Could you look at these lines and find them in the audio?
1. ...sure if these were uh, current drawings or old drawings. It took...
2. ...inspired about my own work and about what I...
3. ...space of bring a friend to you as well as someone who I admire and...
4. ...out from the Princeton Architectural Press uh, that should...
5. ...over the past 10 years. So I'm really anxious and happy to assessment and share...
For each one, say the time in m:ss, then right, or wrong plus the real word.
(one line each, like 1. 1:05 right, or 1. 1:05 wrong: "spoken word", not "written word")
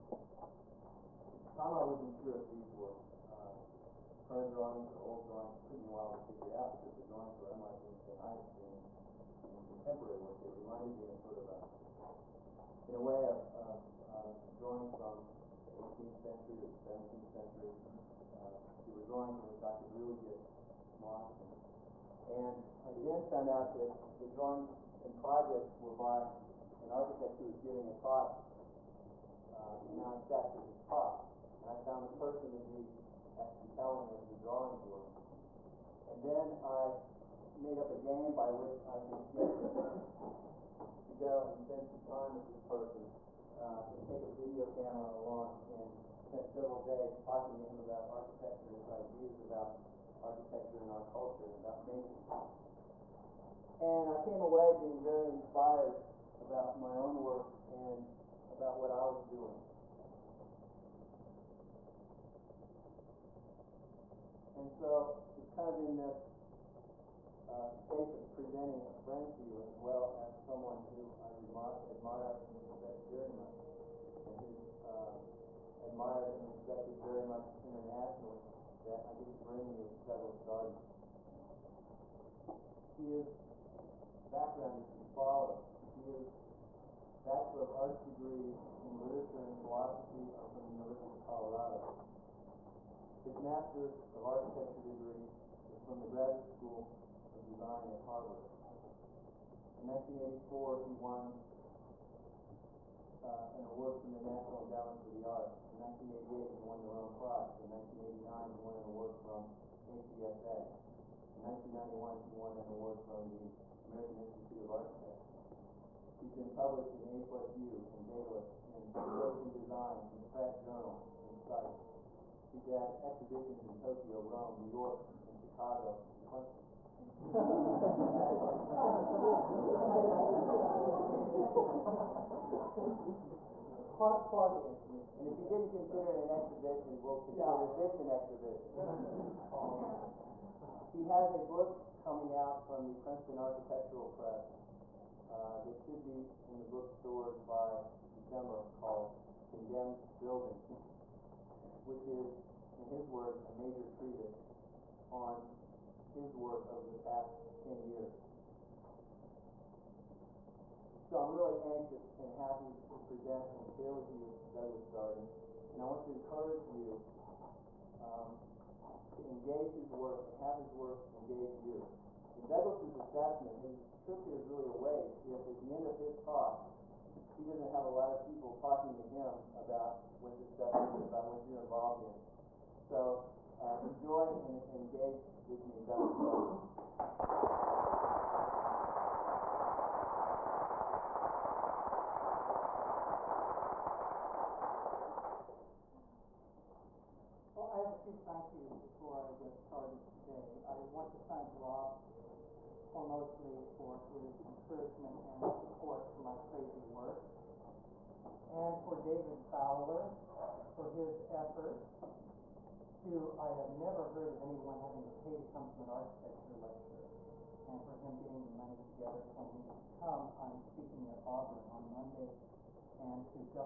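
1. 0:02 right
2. 0:55 right
3. 1:07 wrong: "presenting", not "bring"
4. 2:22 right
5. 2:36 wrong: "present", not "assessment".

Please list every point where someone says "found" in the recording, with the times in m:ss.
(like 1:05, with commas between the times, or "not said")
0:23, 0:31.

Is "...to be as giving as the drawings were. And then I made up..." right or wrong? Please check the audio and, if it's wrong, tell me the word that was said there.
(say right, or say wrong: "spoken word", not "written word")
wrong: "compelling", not "giving".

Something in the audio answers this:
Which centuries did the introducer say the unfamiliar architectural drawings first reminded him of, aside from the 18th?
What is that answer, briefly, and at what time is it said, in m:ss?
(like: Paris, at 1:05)
17th century, at 0:16.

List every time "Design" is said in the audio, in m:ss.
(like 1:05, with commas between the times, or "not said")
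1:37, 1:59.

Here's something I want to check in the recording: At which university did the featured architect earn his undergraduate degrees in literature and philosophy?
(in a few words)
University of Colorado.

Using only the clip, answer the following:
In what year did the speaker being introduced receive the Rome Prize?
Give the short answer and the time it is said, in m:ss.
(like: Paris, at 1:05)
1988, at 1:46.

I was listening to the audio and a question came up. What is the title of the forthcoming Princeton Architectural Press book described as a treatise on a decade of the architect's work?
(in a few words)
Condemned Building.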